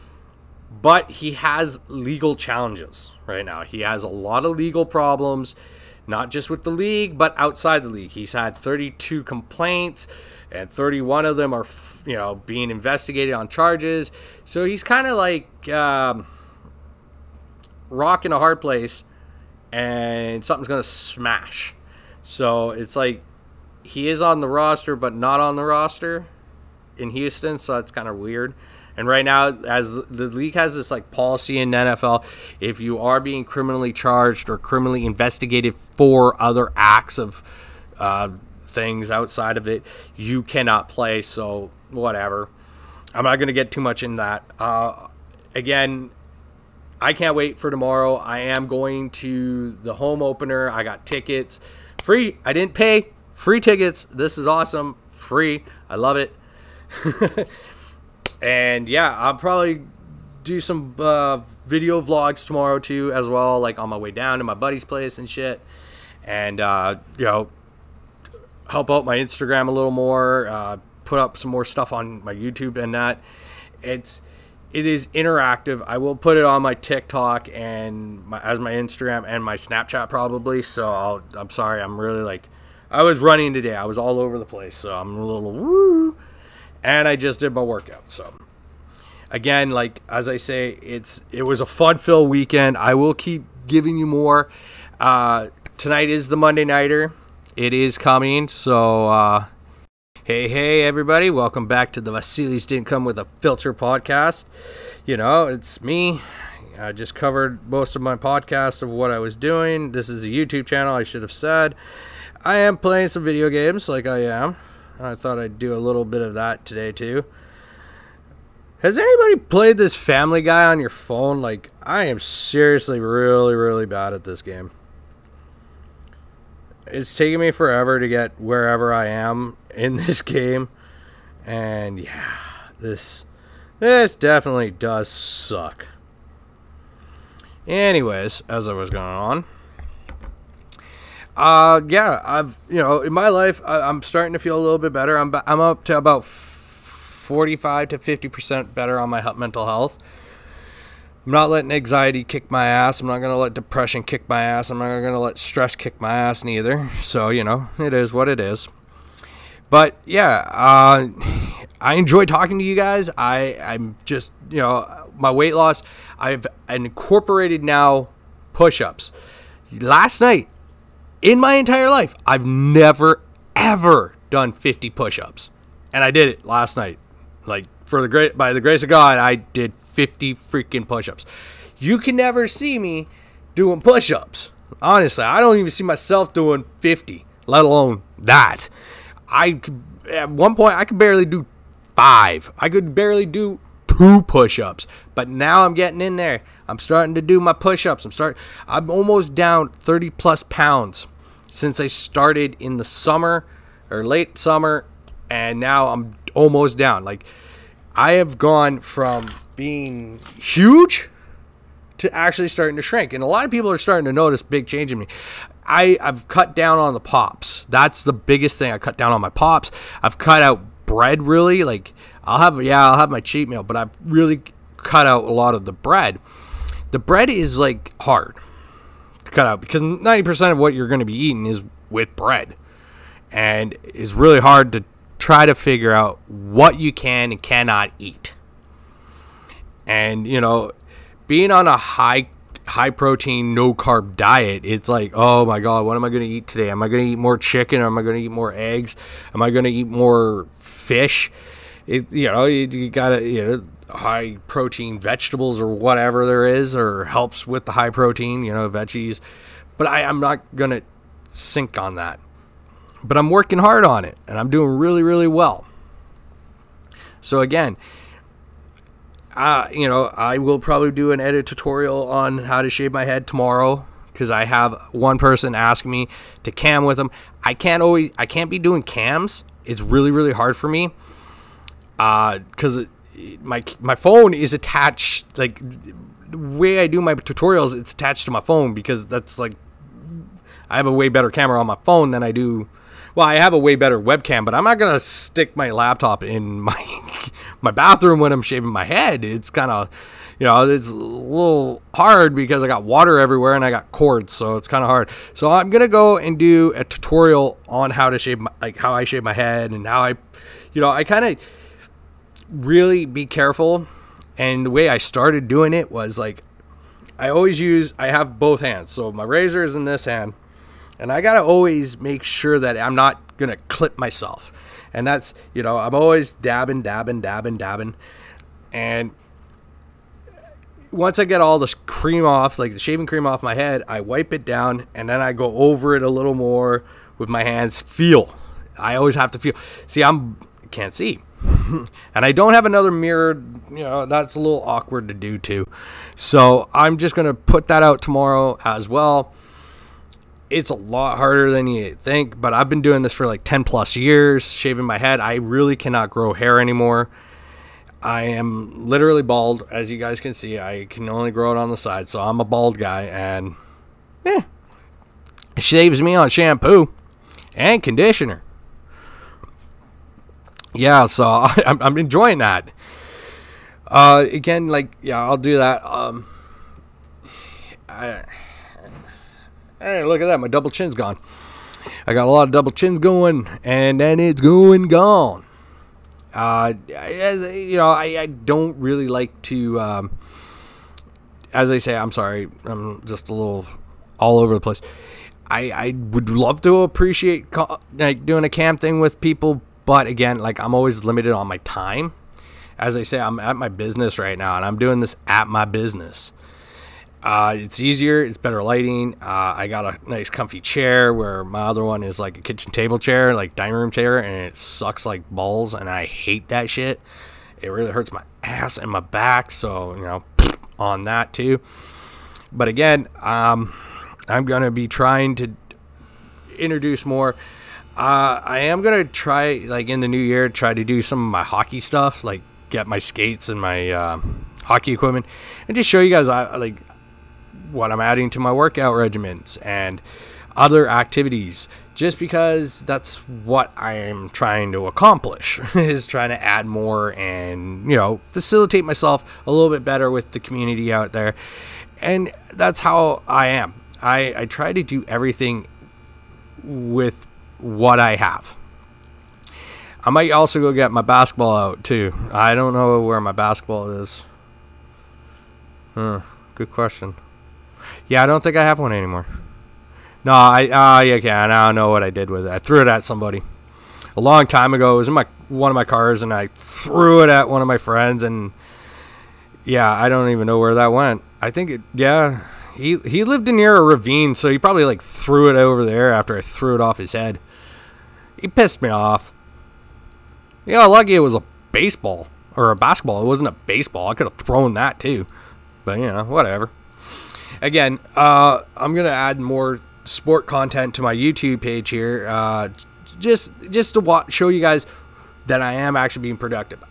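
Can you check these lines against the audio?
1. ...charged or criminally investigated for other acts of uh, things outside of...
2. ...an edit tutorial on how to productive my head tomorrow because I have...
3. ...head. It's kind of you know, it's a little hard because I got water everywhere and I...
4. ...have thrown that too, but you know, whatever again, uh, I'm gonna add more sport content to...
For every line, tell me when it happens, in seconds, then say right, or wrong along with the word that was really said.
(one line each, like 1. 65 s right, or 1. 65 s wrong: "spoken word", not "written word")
1. 33 s right
2. 271 s wrong: "shave", not "productive"
3. 298 s right
4. 494 s right.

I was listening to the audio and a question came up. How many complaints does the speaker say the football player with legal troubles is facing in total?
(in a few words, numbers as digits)
32.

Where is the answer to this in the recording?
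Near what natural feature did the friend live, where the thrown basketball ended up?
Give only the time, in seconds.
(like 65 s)
483 s.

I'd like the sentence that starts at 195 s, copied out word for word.
But now I'm getting in there.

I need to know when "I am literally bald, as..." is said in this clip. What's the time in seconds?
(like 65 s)
358 s.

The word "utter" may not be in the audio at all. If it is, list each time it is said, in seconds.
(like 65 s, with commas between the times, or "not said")
not said.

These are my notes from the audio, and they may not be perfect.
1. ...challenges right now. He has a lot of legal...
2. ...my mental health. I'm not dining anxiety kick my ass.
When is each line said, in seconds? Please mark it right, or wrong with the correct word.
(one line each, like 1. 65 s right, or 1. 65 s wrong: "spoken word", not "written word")
1. 2 s right
2. 149 s wrong: "letting", not "dining".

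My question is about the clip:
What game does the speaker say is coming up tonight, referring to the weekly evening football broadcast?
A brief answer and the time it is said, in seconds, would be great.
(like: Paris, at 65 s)
Monday nighter, at 96 s.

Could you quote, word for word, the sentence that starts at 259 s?
But I, I'm not gonna sink on that.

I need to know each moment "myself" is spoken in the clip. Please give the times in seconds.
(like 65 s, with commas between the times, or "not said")
185 s, 323 s, 448 s.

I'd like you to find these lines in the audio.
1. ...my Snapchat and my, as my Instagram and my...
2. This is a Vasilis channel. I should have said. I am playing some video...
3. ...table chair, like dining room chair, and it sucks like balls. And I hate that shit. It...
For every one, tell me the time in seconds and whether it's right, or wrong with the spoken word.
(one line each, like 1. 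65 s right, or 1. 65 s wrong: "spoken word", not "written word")
1. 76 s wrong: "TikTok", not "Snapchat"
2. 109 s wrong: "YouTube", not "Vasilis"
3. 412 s right.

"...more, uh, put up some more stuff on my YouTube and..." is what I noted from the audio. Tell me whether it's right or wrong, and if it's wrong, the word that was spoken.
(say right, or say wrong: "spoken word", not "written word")
right.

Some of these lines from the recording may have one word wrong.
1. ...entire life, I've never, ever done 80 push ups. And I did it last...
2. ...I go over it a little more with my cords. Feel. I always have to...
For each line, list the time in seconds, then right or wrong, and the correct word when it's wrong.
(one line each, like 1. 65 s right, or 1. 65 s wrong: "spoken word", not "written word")
1. 171 s wrong: "50", not "80"
2. 335 s wrong: "hands", not "cords".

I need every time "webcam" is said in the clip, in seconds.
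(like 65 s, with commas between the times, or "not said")
293 s.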